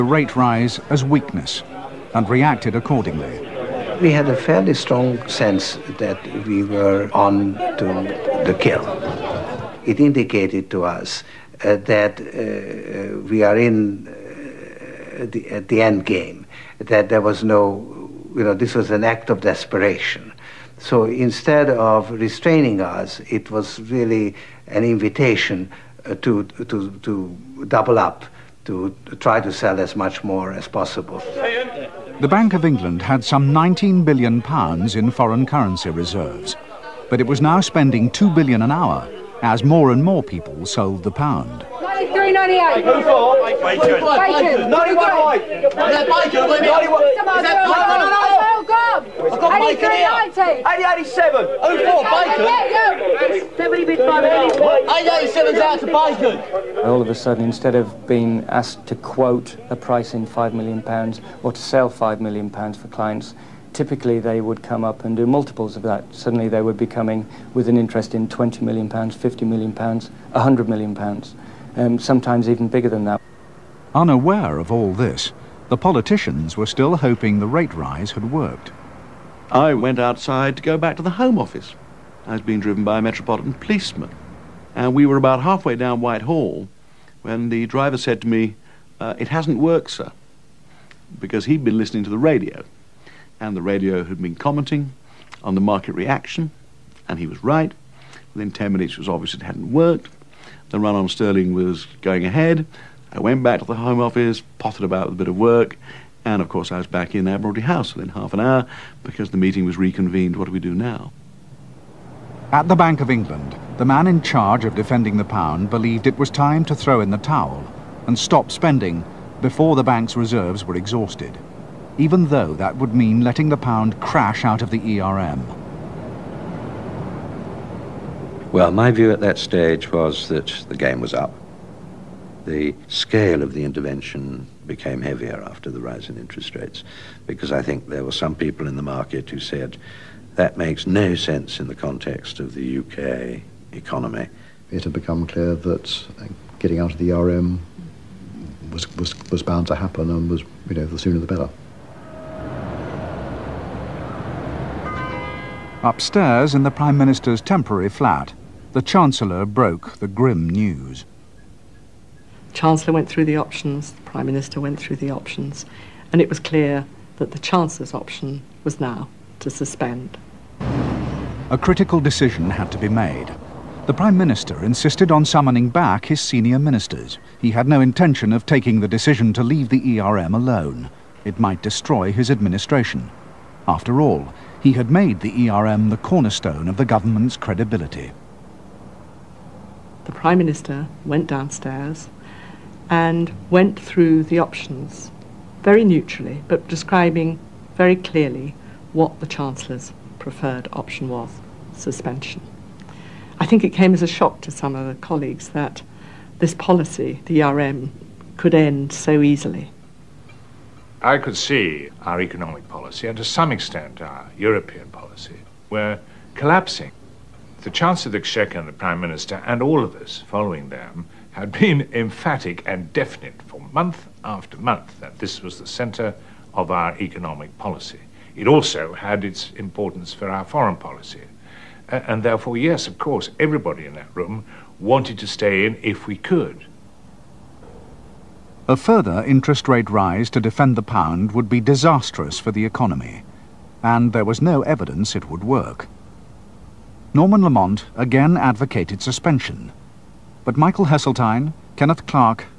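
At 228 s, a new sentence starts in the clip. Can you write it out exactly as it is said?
It also had its importance for our foreign policy.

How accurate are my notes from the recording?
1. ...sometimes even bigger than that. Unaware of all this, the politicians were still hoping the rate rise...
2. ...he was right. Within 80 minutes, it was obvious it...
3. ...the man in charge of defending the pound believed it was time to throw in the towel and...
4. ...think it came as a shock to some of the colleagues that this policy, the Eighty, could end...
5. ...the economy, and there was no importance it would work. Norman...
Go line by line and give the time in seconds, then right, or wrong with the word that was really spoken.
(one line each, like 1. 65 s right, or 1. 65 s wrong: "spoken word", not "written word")
1. 71 s right
2. 97 s wrong: "10", not "80"
3. 113 s right
4. 203 s wrong: "ERM", not "Eighty"
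5. 242 s wrong: "evidence", not "importance".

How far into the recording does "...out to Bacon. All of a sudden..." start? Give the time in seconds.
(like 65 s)
55 s.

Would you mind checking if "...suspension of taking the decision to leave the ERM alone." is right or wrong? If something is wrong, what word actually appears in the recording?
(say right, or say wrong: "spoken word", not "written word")
wrong: "intention", not "suspension".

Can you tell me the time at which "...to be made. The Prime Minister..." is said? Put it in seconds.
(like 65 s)
172 s.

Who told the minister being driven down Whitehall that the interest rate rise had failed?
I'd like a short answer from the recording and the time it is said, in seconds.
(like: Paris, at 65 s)
A metropolitan policeman, at 83 s.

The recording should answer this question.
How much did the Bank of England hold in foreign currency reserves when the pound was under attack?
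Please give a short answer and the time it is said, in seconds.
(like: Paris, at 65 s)
19 billion pounds, at 33 s.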